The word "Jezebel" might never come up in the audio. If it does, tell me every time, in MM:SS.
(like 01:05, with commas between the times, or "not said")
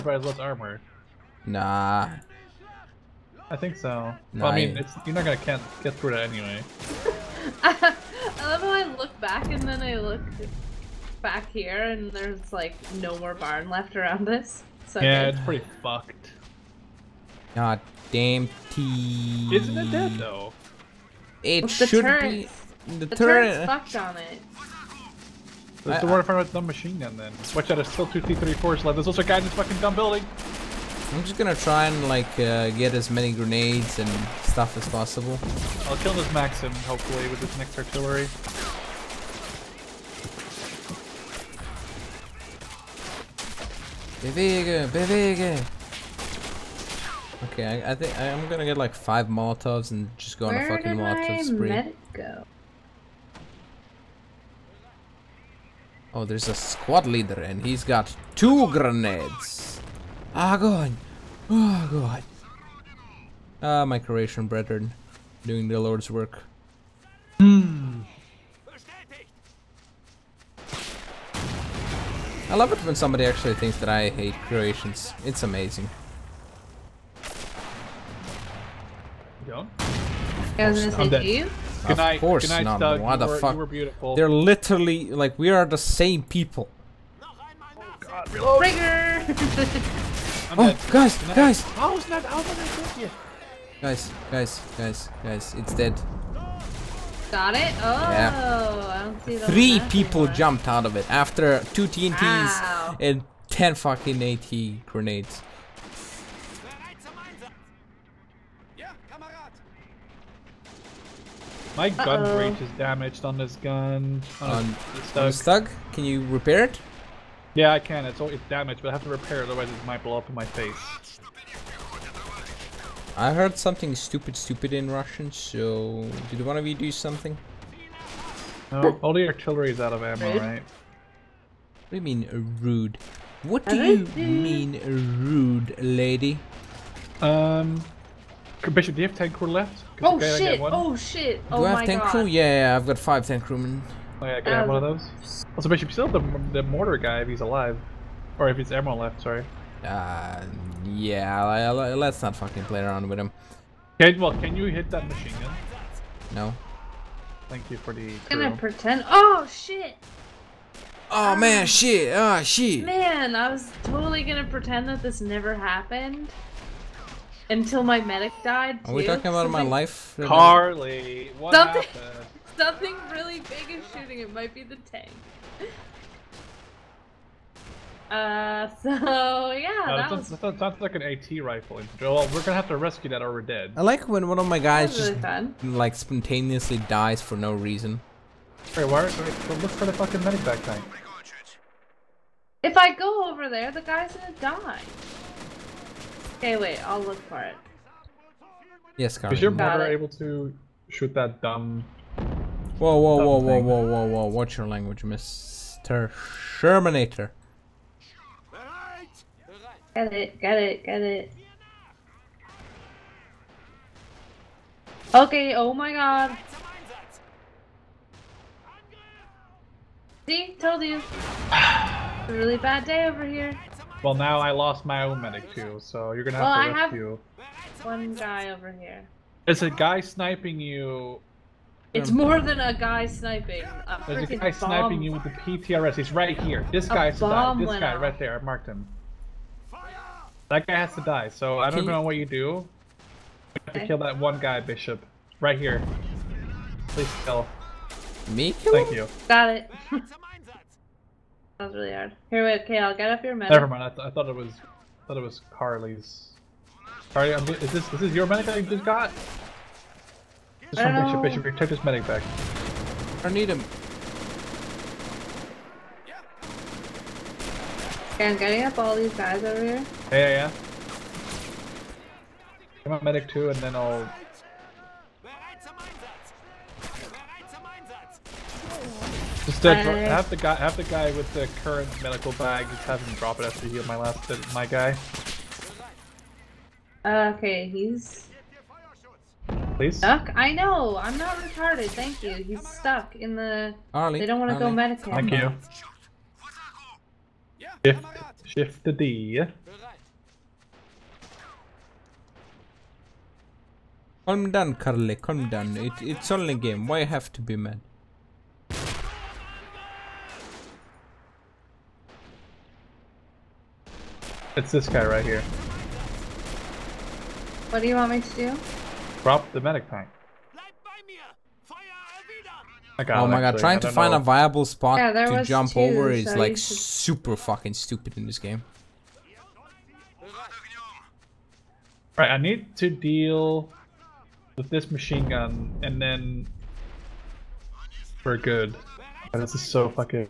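not said.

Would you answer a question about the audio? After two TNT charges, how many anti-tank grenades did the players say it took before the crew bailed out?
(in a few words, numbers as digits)
10.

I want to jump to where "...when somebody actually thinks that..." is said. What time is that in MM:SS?
01:12.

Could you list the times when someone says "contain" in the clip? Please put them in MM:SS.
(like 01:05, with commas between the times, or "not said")
not said.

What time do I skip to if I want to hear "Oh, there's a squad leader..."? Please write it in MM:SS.
00:56.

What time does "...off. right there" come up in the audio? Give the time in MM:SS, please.
03:57.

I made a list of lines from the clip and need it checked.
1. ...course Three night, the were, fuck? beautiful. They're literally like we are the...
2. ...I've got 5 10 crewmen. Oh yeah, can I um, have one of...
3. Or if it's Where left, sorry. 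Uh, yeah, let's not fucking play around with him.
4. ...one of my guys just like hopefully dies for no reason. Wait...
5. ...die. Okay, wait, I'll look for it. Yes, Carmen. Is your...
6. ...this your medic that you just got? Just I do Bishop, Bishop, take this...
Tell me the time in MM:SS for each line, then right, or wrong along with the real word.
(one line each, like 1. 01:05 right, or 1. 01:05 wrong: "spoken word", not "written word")
1. 01:22 wrong: "Good", not "Three"
2. 02:22 right
3. 02:28 wrong: "Emerald", not "Where"
4. 03:04 wrong: "spontaneously", not "hopefully"
5. 03:14 right
6. 04:18 right.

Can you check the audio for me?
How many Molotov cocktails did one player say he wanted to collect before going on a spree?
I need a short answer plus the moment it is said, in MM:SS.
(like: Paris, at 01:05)
5, at 00:48.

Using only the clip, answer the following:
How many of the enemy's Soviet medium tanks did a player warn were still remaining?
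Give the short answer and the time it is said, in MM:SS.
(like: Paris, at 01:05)
2, at 00:28.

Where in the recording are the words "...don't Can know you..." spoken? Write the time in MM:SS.
04:01.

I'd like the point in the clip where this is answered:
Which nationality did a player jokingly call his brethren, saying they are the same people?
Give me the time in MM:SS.
01:03.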